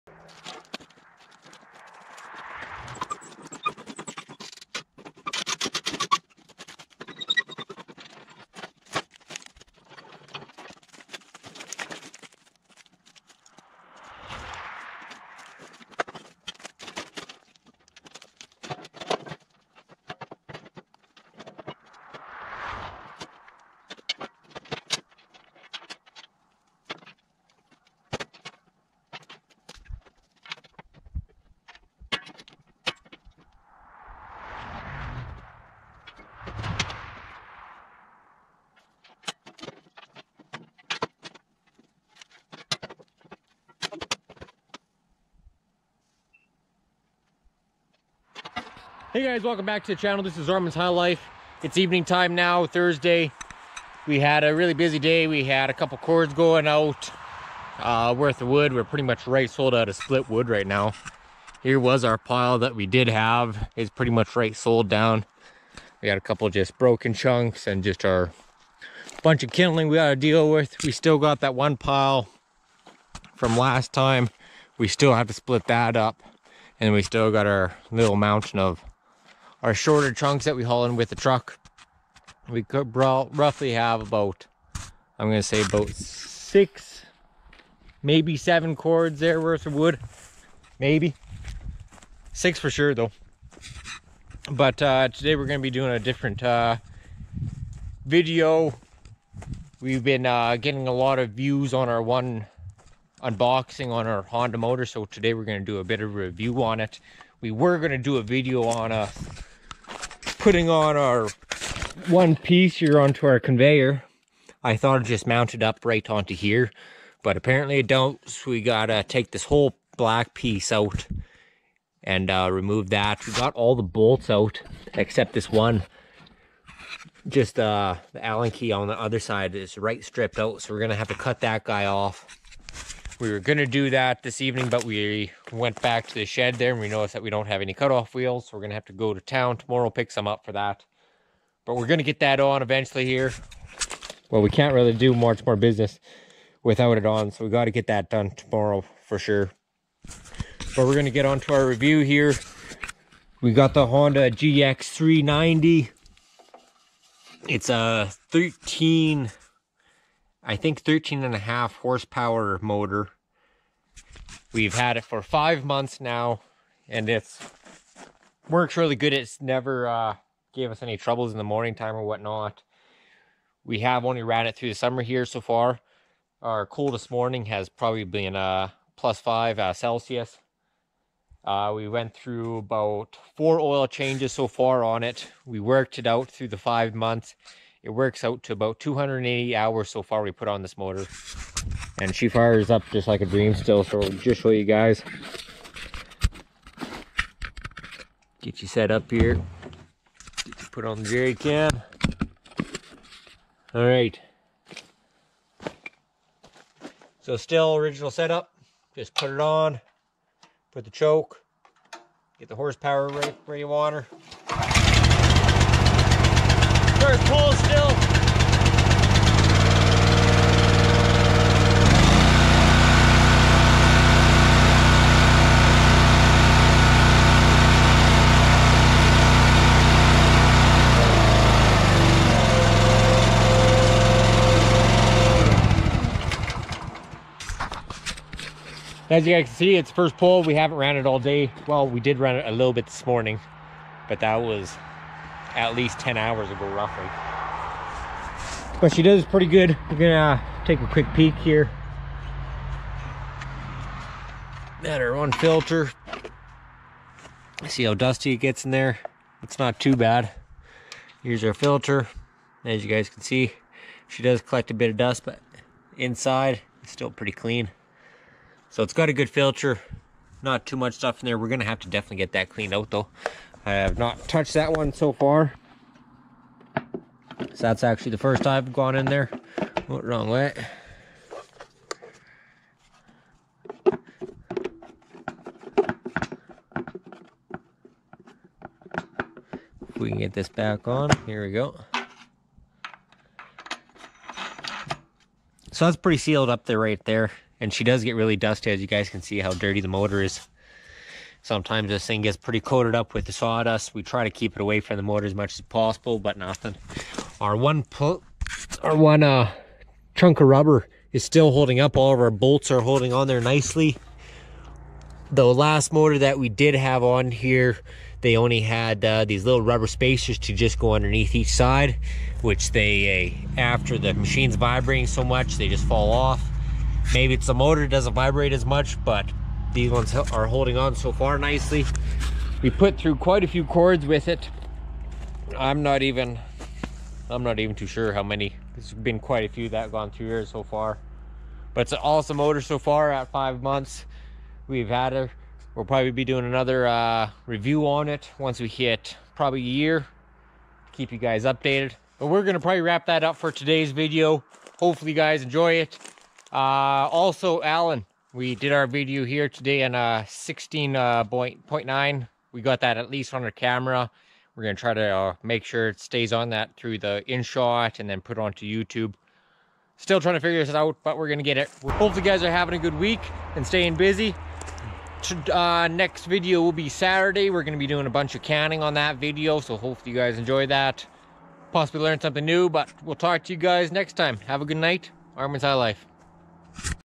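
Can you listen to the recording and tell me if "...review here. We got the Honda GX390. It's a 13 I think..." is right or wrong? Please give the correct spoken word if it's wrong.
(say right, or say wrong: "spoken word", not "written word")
right.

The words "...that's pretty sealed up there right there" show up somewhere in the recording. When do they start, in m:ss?
4:55.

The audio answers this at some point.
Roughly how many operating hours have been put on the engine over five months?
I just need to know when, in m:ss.
3:08.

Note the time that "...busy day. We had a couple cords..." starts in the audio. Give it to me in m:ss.
0:54.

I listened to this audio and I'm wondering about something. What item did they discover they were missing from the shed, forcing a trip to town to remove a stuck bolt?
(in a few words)
cutoff wheels.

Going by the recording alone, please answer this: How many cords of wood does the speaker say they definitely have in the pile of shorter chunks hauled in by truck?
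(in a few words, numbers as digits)
6.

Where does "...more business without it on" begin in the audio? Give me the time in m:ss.
2:25.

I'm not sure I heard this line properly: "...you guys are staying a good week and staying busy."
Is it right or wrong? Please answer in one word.
wrong.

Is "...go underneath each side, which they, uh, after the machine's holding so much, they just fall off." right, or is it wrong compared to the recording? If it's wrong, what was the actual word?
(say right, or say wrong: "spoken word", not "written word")
wrong: "vibrating", not "holding".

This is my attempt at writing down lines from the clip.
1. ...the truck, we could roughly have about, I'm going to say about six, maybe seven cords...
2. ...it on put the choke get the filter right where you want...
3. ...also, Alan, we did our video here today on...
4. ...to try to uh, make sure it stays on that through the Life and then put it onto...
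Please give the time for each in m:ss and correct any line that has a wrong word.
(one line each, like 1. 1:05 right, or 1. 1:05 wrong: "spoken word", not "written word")
1. 1:21 right
2. 3:29 wrong: "horsepower", not "filter"
3. 5:57 right
4. 6:04 wrong: "InShot", not "Life".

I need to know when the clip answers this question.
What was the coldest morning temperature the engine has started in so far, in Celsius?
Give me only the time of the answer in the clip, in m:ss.
2:58.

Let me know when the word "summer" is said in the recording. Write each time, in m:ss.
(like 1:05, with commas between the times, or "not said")
2:54.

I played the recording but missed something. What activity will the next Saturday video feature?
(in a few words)
canning.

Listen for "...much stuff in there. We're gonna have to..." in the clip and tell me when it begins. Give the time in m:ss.
4:30.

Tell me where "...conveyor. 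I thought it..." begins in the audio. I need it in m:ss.
1:53.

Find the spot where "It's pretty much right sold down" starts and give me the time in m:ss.
1:03.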